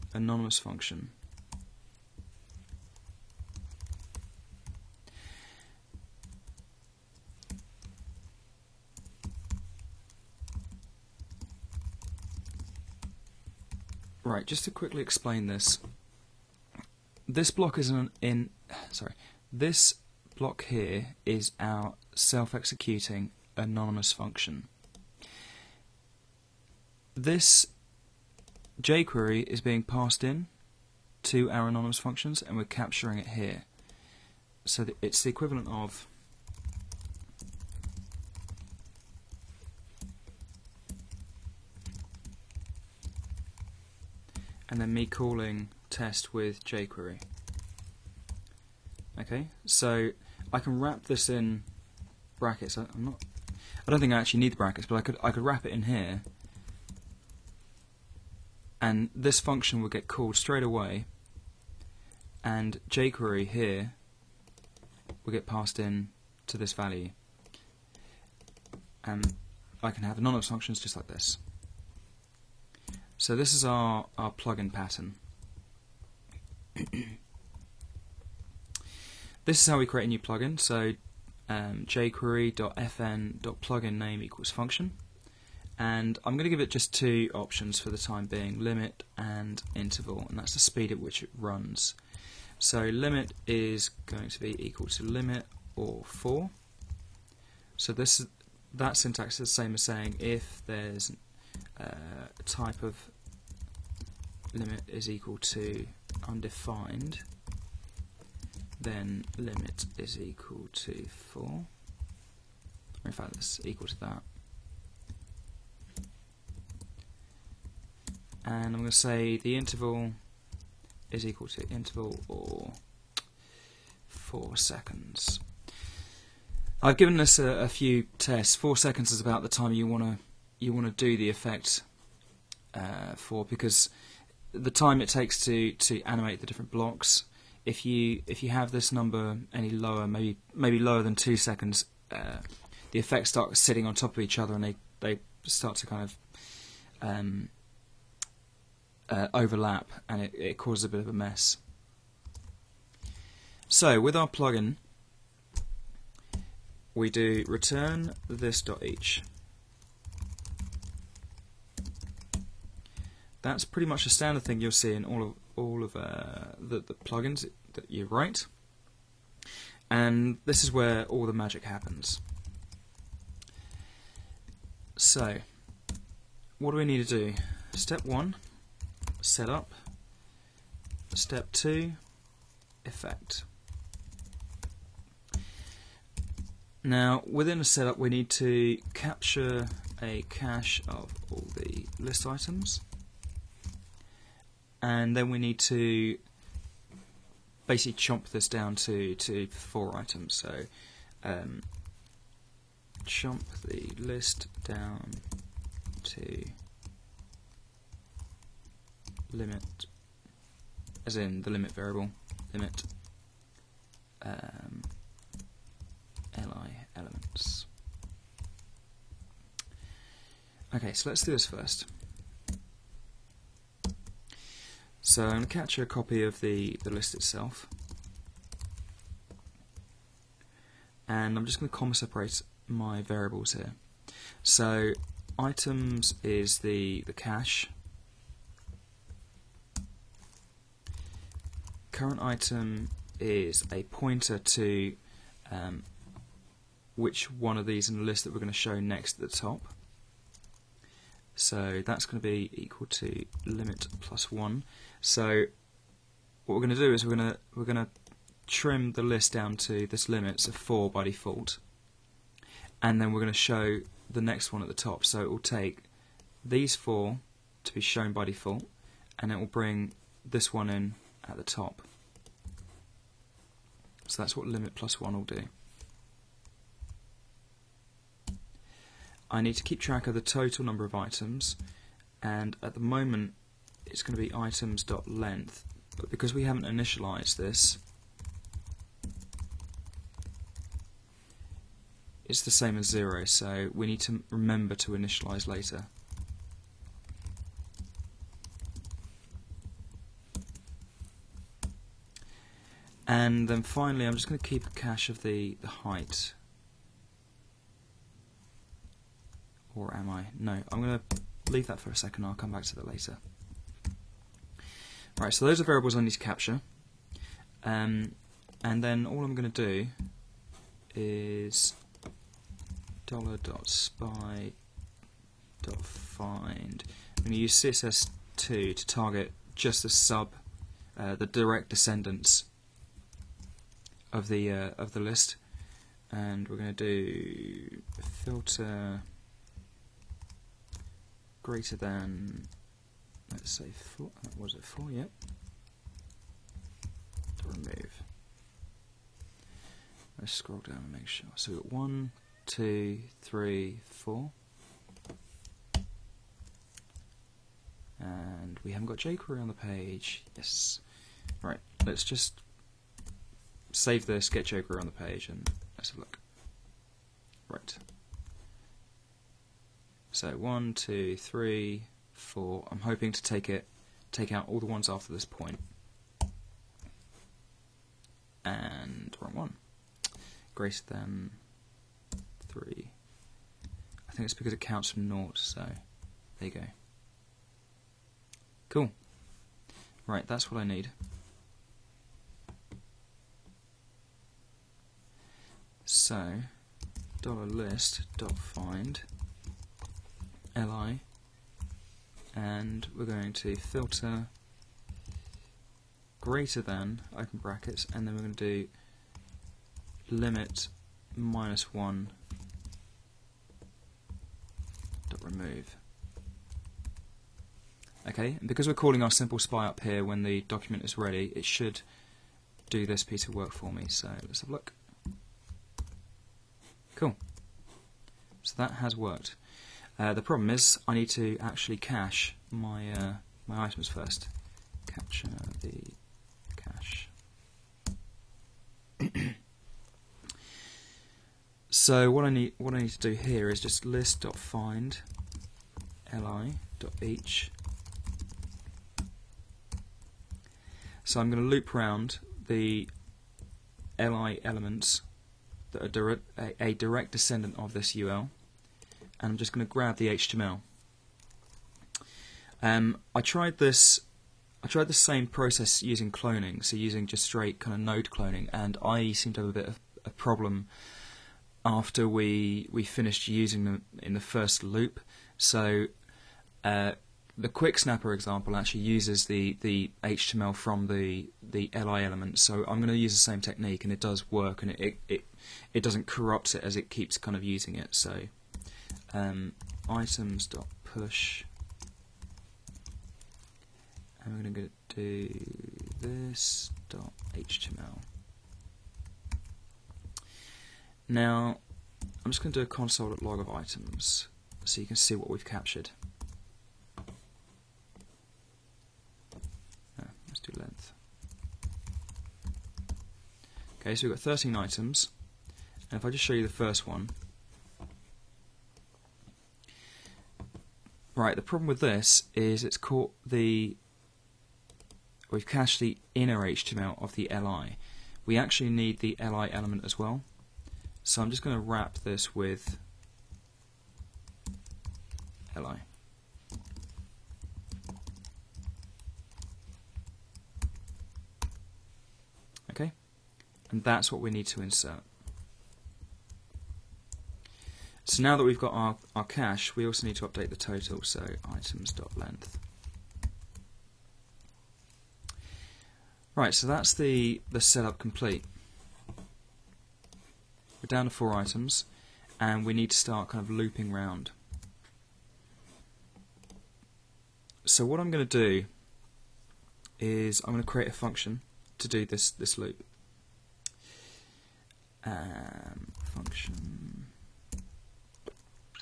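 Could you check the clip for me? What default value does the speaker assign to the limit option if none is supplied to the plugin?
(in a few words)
4.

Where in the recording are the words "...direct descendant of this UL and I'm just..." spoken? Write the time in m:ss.
7:36.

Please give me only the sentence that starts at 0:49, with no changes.
Okay, so I can wrap this in brackets.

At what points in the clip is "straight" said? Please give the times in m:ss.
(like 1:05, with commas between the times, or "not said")
1:00, 7:47.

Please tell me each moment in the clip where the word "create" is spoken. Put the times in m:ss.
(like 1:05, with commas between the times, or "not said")
1:19, 9:30.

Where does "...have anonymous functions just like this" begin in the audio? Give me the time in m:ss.
1:10.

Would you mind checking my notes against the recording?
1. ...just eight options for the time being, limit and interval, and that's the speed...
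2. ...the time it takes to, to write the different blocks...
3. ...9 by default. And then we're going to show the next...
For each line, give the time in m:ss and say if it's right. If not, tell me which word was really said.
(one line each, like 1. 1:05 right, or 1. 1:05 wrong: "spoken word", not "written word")
1. 1:26 wrong: "two", not "eight"
2. 2:14 wrong: "animate", not "write"
3. 4:20 wrong: "4", not "9".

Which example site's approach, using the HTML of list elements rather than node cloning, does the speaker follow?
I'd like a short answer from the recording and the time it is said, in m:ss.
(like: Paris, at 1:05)
QuickSnapper, at 7:57.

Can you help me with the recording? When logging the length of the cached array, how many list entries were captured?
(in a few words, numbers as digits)
13.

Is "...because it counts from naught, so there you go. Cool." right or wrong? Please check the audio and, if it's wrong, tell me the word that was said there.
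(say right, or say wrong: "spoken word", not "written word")
right.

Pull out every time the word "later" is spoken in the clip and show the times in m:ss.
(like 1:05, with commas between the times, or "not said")
4:55, 5:12.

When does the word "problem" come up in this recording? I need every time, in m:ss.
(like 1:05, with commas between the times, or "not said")
7:10, 7:50, 8:41.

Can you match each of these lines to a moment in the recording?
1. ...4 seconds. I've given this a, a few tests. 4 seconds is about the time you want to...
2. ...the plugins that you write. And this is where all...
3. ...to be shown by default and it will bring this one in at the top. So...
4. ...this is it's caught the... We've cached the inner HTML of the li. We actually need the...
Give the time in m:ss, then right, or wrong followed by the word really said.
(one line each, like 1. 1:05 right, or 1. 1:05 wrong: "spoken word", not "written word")
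1. 2:04 right
2. 2:46 right
3. 4:27 right
4. 8:41 right.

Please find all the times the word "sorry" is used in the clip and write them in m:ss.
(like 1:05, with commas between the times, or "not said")
0:18.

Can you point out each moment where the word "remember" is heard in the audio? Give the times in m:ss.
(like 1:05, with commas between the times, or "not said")
4:54.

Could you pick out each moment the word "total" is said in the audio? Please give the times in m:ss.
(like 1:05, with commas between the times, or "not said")
4:40, 9:10.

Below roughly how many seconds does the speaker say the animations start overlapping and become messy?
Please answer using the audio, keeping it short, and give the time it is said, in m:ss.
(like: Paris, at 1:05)
2 seconds, at 2:21.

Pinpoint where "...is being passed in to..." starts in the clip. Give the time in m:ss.
0:29.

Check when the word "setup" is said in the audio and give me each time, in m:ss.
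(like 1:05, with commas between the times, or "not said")
2:59, 3:07, 9:17.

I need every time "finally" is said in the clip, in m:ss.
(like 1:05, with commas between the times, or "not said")
5:03.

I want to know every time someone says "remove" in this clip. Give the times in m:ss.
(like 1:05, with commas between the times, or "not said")
5:47, 6:55.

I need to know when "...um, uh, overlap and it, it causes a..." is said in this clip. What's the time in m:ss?
2:27.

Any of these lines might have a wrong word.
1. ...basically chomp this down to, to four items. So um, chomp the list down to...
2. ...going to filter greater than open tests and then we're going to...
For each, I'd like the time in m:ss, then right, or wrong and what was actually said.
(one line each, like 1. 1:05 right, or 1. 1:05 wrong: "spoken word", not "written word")
1. 3:17 right
2. 6:43 wrong: "brackets", not "tests".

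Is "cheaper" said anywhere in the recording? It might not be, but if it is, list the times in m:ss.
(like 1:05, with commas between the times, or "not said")
not said.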